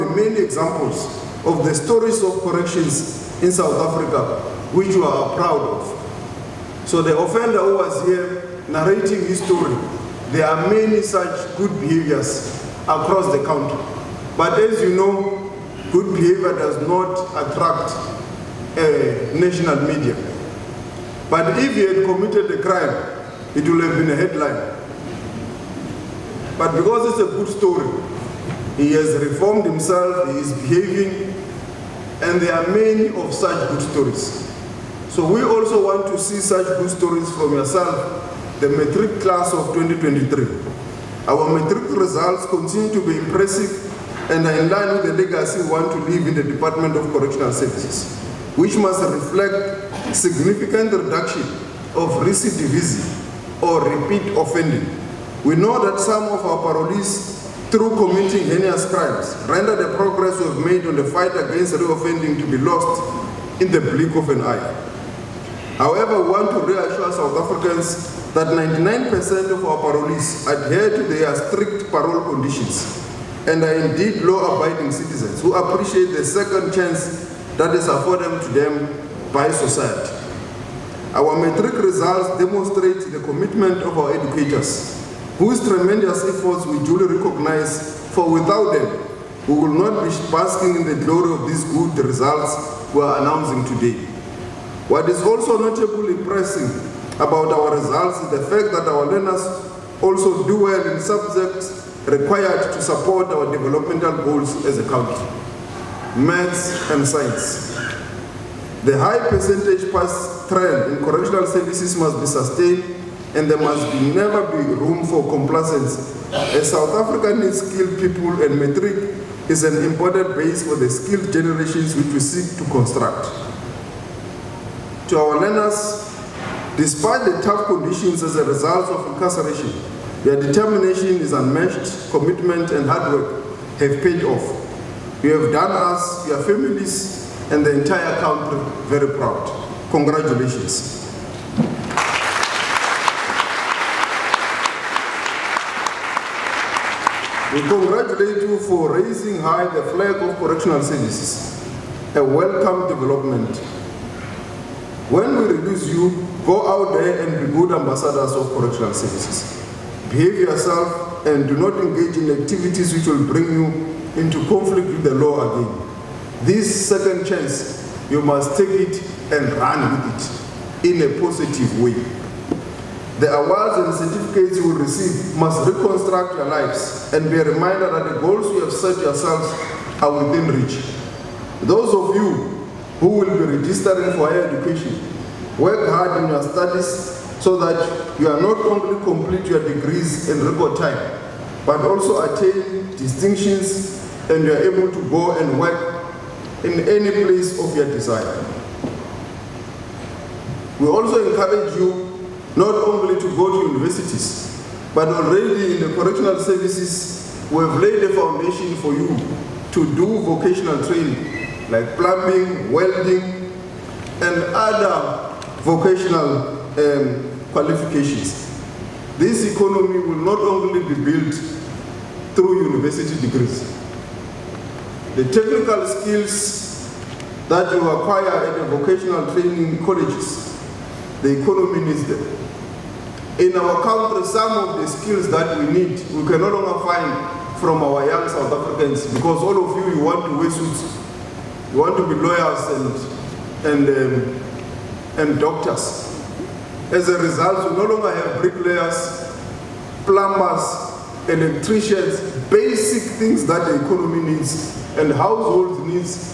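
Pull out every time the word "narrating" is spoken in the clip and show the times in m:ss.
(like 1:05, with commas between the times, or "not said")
0:08.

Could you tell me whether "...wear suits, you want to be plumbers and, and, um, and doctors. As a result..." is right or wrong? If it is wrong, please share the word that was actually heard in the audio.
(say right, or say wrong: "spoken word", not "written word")
wrong: "lawyers", not "plumbers".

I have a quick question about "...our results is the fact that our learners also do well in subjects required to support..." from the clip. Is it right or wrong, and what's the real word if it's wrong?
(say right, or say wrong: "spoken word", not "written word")
right.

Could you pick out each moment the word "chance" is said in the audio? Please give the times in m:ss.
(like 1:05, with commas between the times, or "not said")
1:16, 2:47.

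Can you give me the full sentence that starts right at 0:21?
But if he had committed a crime, it would have been a headline.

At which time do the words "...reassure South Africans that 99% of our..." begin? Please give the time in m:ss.
1:06.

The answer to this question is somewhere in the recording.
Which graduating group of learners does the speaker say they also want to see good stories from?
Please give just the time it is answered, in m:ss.
0:38.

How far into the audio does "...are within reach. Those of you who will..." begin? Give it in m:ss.
3:00.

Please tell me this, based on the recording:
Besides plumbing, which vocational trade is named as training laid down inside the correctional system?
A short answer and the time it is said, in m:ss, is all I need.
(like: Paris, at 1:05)
Welding, at 3:32.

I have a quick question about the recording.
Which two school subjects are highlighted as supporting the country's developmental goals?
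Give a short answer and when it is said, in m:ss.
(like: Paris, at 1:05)
Maths and science, at 1:46.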